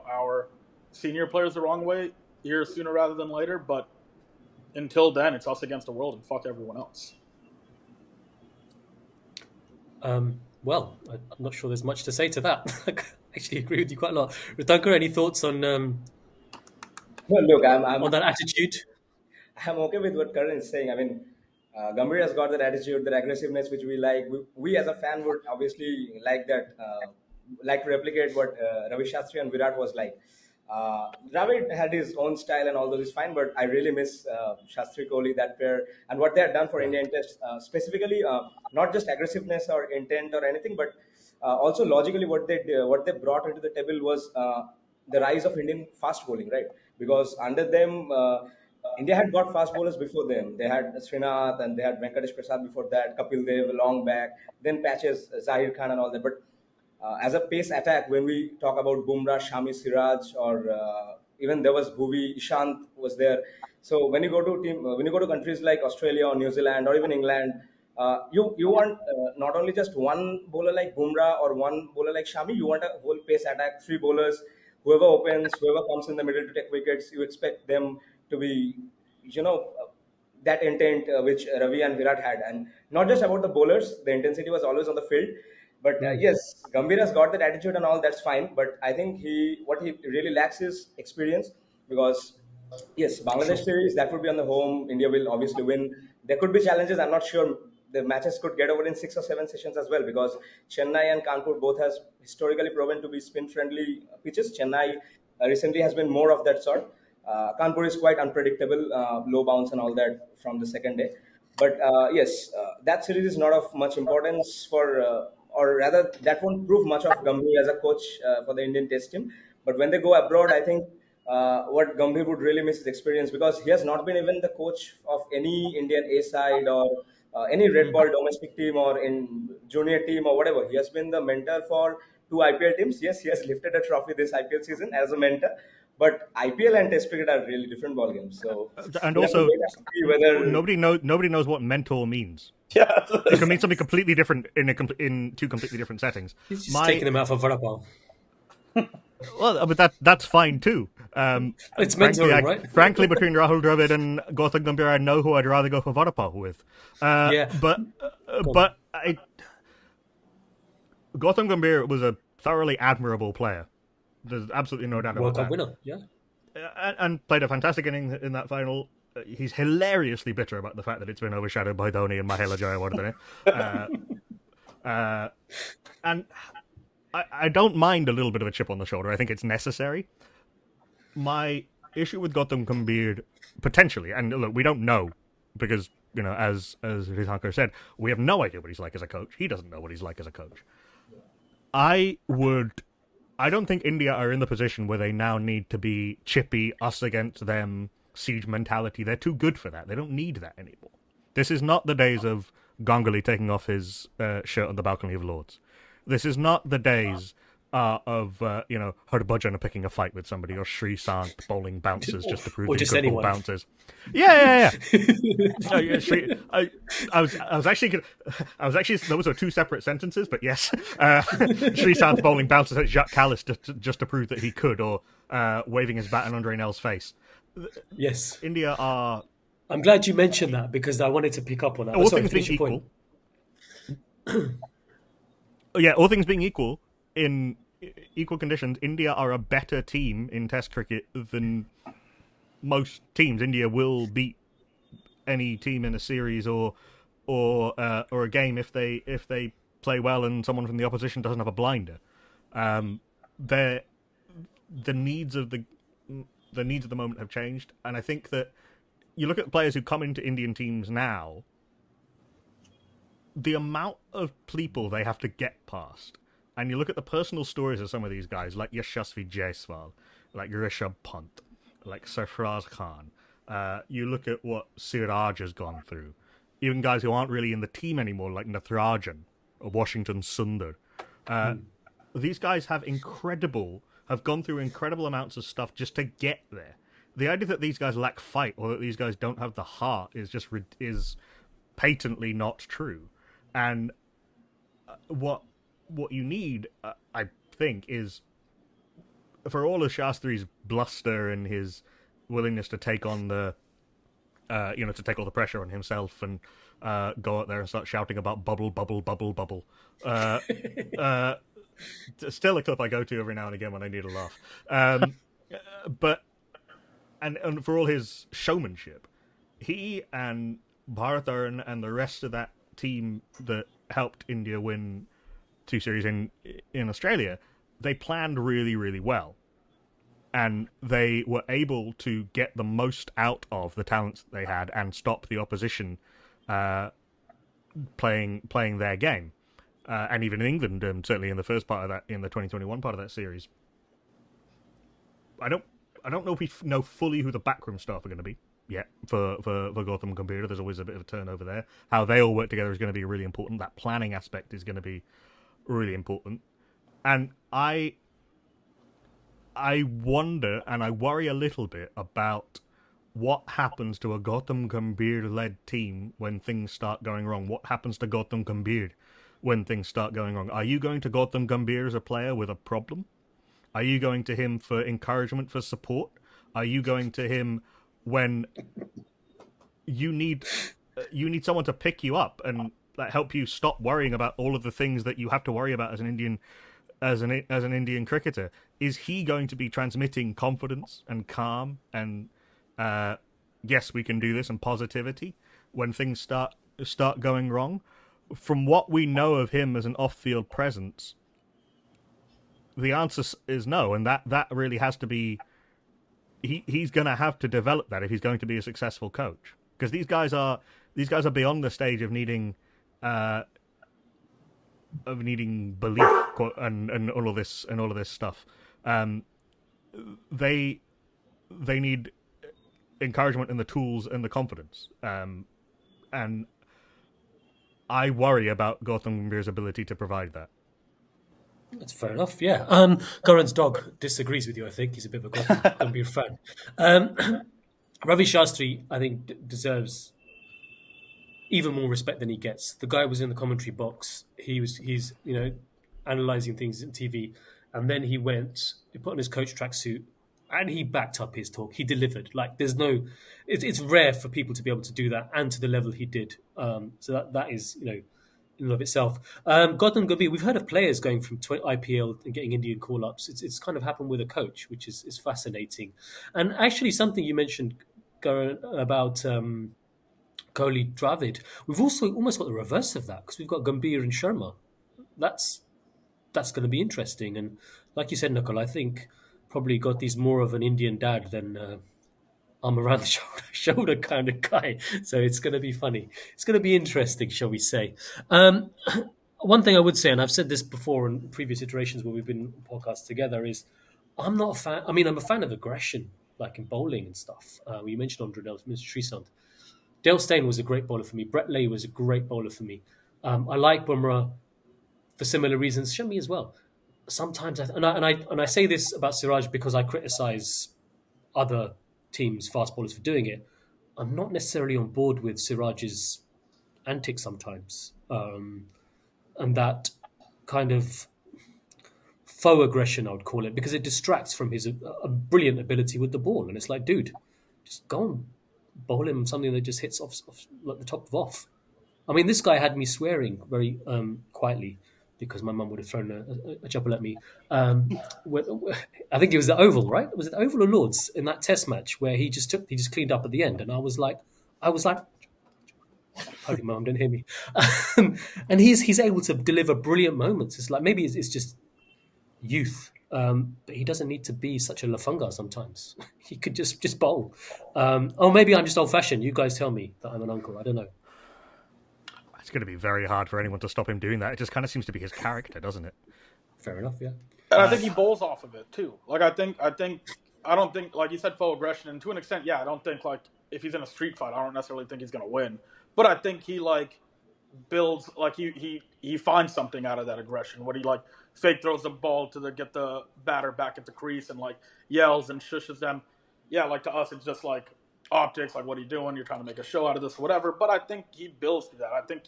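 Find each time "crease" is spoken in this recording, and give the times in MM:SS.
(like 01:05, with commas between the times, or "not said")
09:43.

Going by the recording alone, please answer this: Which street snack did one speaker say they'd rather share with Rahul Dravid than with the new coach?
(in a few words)
vada pav.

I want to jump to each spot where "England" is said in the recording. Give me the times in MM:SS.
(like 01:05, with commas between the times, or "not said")
01:07, 05:40.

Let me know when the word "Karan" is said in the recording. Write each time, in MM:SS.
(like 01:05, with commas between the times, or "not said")
00:20.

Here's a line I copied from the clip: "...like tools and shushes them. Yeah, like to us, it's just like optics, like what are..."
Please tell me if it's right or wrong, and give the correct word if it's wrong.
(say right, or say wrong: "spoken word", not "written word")
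wrong: "yells", not "tools".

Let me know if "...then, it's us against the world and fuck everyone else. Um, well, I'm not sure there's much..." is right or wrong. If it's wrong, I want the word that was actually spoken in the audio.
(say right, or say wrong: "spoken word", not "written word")
right.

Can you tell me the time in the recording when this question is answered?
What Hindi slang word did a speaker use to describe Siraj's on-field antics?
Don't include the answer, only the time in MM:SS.
09:14.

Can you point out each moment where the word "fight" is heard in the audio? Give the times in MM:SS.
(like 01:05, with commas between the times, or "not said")
03:29, 04:48, 09:34.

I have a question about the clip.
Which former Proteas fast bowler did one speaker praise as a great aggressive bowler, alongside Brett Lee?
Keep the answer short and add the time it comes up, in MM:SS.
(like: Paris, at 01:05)
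Dale Steyn, at 08:20.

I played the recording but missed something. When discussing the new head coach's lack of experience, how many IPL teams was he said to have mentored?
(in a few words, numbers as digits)
2.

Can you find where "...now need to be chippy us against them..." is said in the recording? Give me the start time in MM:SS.
03:15.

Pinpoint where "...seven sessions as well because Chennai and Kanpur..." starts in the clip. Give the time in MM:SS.
01:39.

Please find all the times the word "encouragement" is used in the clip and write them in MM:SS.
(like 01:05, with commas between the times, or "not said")
06:14, 07:03.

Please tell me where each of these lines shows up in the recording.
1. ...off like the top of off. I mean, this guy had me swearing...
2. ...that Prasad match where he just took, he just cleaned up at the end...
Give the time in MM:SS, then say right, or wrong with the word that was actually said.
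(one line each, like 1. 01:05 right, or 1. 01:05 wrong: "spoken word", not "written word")
1. 08:50 right
2. 09:01 wrong: "Test", not "Prasad".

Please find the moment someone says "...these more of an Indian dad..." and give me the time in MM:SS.
07:59.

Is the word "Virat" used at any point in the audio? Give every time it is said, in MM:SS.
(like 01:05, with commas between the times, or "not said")
00:29, 01:21.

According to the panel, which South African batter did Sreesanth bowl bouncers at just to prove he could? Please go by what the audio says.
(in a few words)
Jacques Kallis.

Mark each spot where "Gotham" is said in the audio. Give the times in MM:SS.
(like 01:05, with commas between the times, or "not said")
07:08, 07:15.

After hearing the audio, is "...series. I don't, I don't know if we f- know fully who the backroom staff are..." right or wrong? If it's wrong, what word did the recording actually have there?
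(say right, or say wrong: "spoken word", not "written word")
right.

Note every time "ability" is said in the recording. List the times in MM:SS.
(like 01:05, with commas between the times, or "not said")
07:09, 08:45.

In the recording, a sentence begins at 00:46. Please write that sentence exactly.
Because under them, India had got fast bowlers before them.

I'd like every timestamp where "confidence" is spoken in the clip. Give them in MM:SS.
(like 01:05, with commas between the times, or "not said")
06:30, 07:04.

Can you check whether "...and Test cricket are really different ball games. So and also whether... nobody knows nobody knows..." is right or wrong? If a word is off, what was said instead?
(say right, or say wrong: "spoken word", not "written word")
right.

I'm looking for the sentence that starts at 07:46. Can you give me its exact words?
And actually, something you mentioned about.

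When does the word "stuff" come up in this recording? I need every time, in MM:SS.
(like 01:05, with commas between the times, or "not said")
04:45, 06:58, 08:17.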